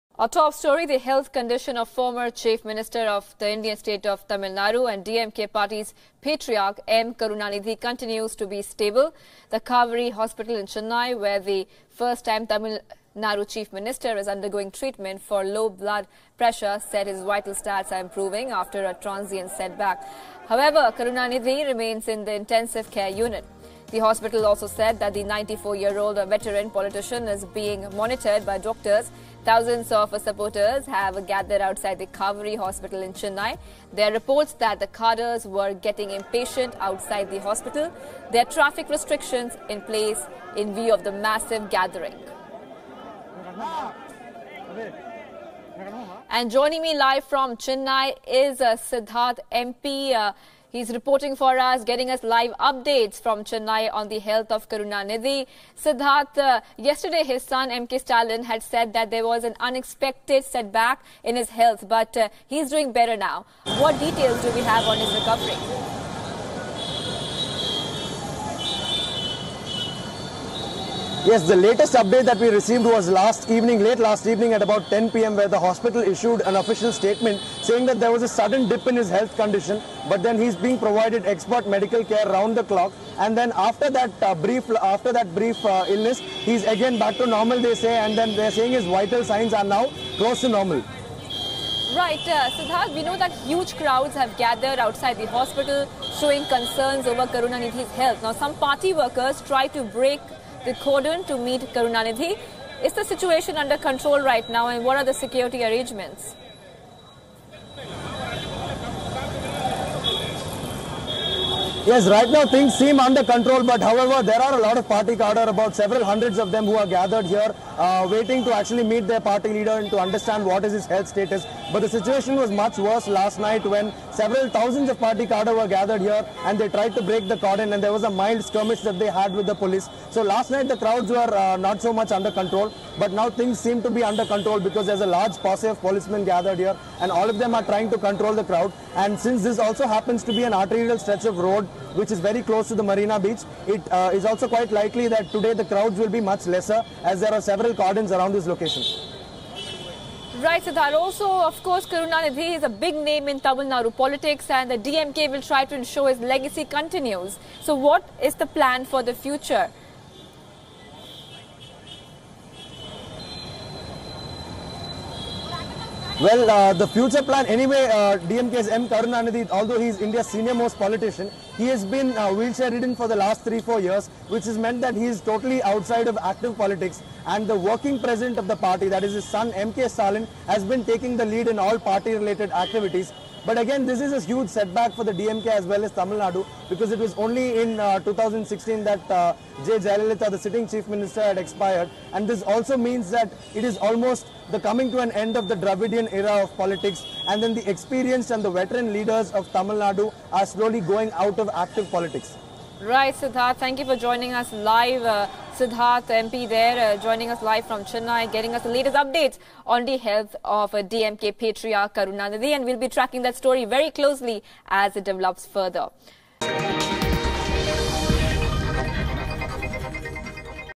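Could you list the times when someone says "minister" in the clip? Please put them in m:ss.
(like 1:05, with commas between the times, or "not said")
0:02, 0:13, 3:10.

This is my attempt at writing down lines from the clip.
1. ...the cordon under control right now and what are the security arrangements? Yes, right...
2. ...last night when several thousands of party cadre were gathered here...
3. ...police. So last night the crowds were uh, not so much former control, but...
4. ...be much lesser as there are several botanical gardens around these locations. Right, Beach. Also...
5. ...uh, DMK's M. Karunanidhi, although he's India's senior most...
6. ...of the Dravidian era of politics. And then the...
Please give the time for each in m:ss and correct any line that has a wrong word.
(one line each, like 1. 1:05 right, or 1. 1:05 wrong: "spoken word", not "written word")
1. 1:42 wrong: "situation", not "cordon"
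2. 2:03 right
3. 2:09 wrong: "under", not "former"
4. 2:26 wrong: "Siddhar", not "Beach"
5. 2:47 right
6. 3:15 right.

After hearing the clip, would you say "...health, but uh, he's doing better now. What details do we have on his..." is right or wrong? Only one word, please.
right.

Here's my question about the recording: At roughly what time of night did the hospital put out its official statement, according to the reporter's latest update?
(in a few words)
10 p.m.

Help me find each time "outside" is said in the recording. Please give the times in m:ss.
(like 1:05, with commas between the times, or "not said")
0:31, 0:36, 1:34, 2:55.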